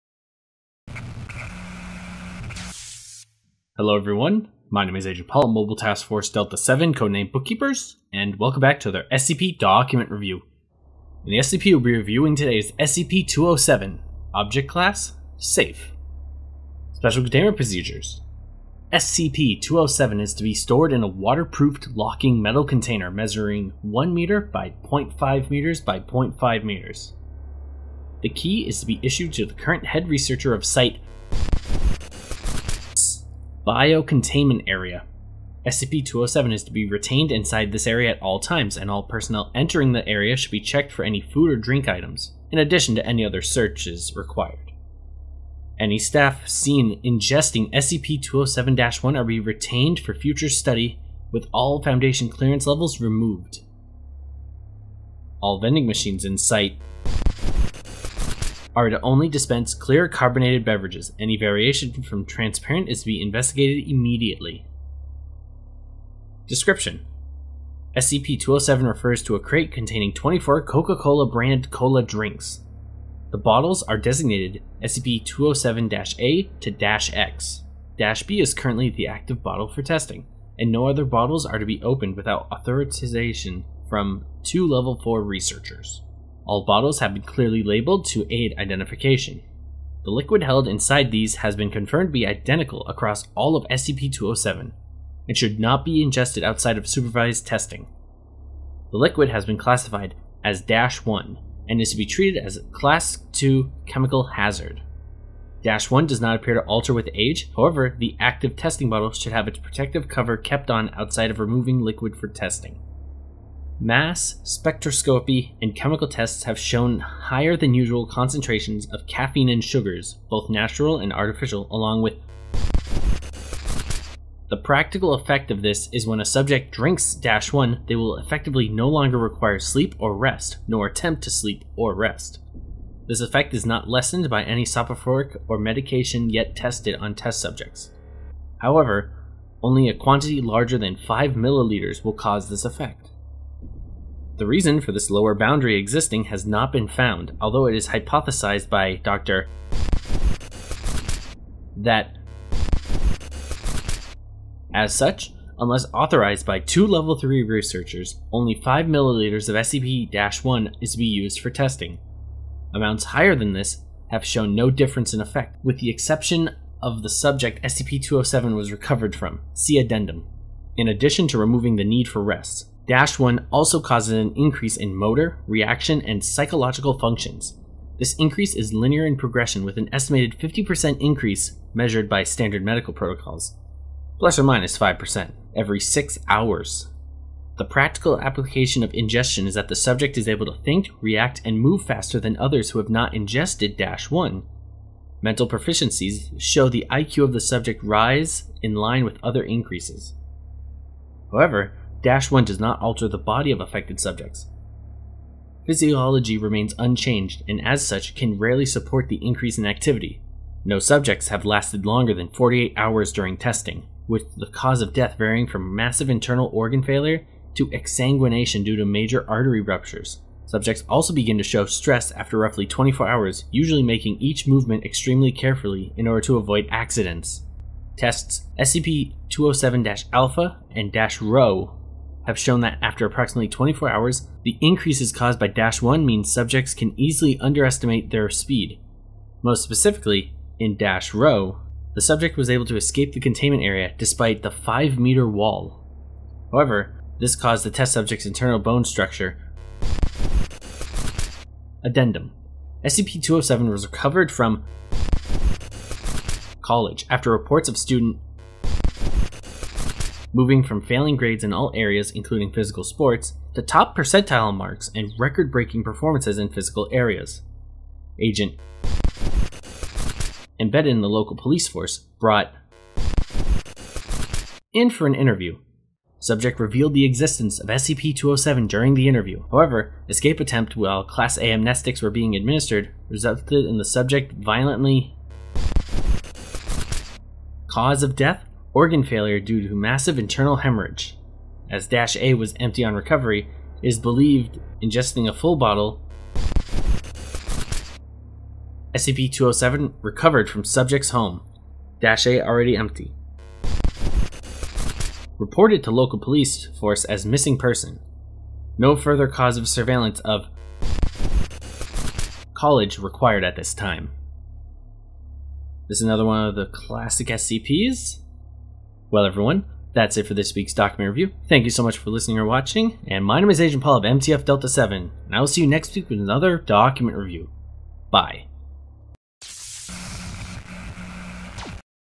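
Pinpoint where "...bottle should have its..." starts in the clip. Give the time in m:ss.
1:48.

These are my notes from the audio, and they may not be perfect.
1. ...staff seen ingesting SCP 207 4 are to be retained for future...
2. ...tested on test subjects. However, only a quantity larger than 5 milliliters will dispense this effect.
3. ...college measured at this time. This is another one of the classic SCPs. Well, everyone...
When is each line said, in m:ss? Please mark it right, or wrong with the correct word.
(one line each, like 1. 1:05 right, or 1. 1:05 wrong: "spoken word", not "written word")
1. 0:45 wrong: "1", not "4"
2. 2:16 wrong: "cause", not "dispense"
3. 5:12 wrong: "required", not "measured".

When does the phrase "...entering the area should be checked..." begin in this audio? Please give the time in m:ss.
0:39.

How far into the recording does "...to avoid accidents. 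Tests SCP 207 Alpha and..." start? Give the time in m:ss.
3:46.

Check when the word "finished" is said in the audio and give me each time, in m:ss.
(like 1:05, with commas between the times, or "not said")
not said.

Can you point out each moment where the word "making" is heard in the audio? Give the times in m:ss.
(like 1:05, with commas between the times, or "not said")
3:43.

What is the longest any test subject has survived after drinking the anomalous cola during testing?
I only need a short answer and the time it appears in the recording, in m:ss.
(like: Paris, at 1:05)
48 hours, at 3:32.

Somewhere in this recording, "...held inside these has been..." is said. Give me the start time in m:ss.
1:30.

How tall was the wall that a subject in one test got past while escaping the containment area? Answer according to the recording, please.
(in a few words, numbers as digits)
5 meters.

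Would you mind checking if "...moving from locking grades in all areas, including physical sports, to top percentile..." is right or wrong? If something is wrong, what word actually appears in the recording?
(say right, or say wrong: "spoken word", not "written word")
wrong: "failing", not "locking".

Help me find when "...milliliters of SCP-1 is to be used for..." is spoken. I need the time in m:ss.
2:38.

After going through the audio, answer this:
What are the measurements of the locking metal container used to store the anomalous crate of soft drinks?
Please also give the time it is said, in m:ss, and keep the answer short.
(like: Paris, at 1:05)
1 meter by 0.5 meters by 0.5 meters, at 0:23.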